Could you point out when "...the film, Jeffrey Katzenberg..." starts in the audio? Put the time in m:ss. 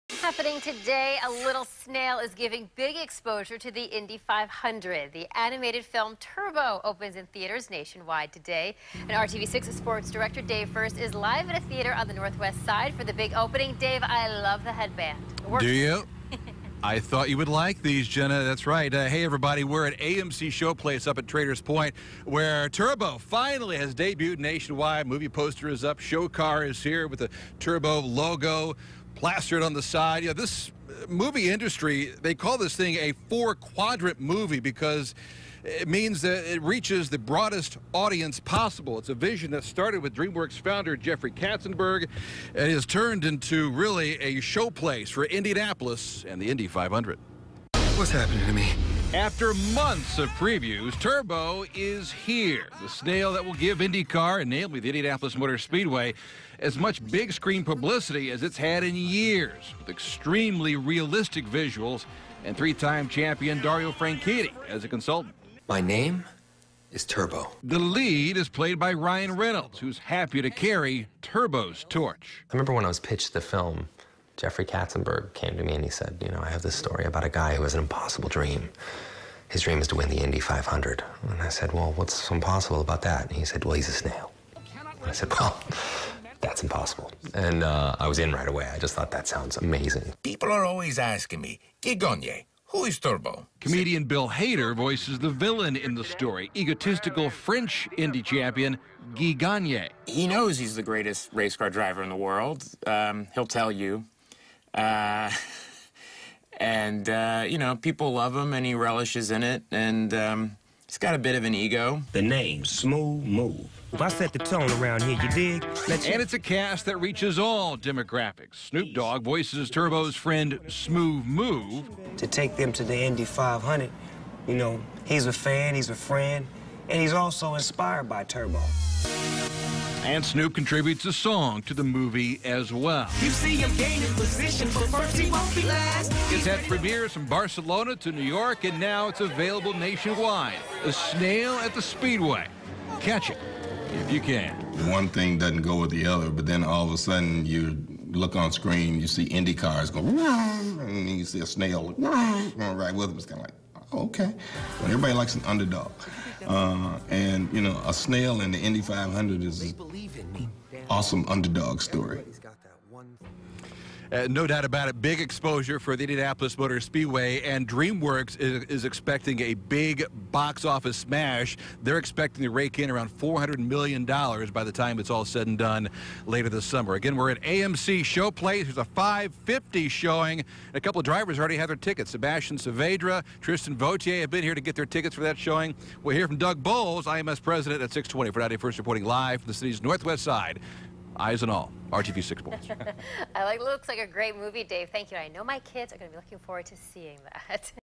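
1:13.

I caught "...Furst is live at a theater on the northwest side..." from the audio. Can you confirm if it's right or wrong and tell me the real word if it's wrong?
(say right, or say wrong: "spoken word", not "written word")
right.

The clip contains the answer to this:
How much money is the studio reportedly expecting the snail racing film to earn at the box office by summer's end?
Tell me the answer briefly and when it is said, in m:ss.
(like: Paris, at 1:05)
$400 million, at 2:53.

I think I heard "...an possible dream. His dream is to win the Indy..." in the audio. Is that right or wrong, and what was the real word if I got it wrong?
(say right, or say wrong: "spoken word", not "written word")
wrong: "impossible", not "possible".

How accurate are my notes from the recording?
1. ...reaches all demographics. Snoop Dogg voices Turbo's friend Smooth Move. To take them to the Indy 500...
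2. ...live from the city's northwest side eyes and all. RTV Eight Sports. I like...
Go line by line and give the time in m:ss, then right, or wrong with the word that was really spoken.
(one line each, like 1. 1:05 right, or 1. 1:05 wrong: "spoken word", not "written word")
1. 1:57 right
2. 3:09 wrong: "Six", not "Eight".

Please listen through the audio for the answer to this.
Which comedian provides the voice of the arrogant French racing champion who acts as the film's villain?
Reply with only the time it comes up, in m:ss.
1:34.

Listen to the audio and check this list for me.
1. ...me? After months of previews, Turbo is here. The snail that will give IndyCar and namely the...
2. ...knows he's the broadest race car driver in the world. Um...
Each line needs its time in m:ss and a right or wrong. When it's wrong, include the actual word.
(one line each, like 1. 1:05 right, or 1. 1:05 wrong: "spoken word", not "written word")
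1. 0:48 right
2. 1:40 wrong: "greatest", not "broadest".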